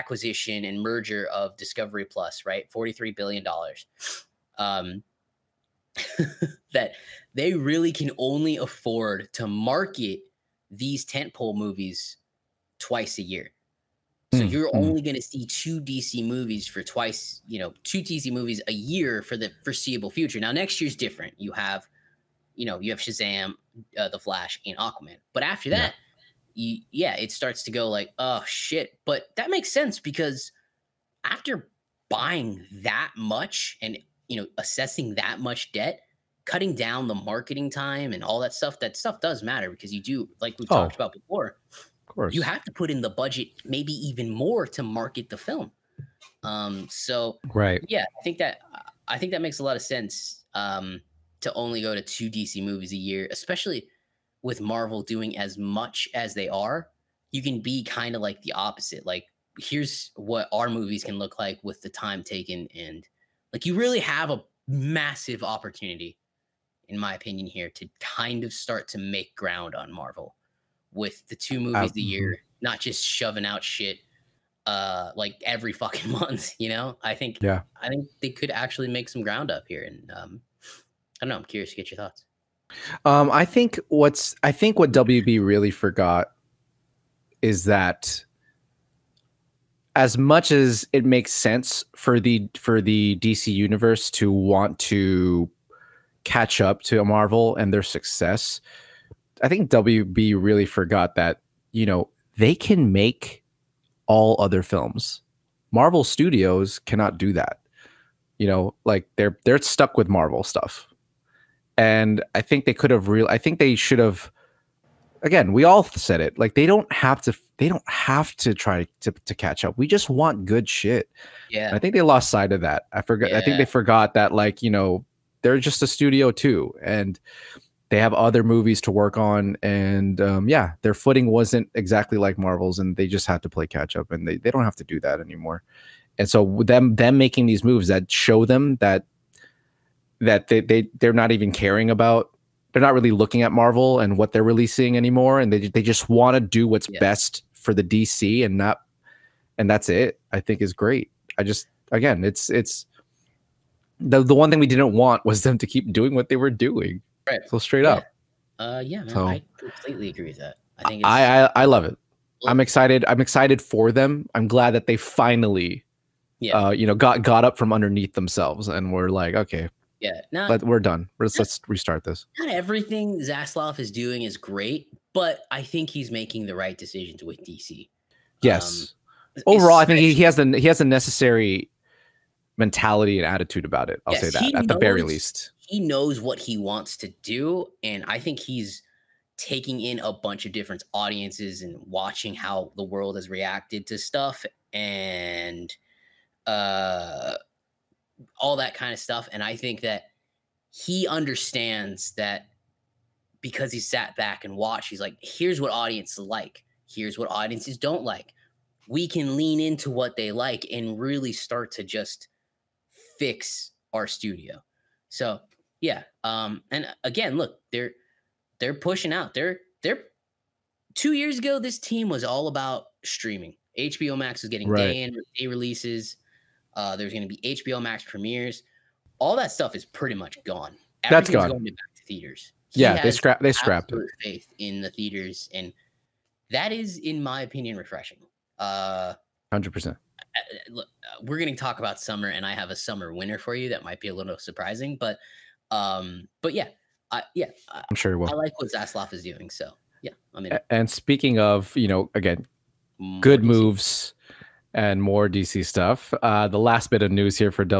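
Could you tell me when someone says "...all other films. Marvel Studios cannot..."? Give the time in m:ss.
1:44.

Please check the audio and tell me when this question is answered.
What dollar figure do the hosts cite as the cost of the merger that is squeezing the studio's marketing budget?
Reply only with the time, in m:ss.
0:02.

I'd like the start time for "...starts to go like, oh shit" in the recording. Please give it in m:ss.
0:27.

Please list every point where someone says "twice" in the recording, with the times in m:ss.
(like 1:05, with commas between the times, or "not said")
0:12, 0:16.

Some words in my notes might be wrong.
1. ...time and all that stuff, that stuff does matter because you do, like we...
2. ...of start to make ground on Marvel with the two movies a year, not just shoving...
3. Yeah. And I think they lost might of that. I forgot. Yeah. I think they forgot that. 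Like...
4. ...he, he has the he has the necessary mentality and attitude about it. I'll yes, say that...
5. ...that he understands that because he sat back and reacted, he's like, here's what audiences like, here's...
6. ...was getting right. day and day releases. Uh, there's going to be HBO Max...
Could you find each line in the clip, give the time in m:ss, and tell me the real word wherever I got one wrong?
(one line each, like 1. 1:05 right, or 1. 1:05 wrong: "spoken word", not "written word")
1. 0:37 right
2. 1:08 right
3. 2:01 wrong: "sight", not "might"
4. 2:59 right
5. 3:19 wrong: "watched", not "reacted"
6. 3:44 right.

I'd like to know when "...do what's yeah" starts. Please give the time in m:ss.
2:26.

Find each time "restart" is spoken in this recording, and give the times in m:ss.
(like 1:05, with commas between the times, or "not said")
2:51.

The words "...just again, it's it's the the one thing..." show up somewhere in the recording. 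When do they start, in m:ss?
2:31.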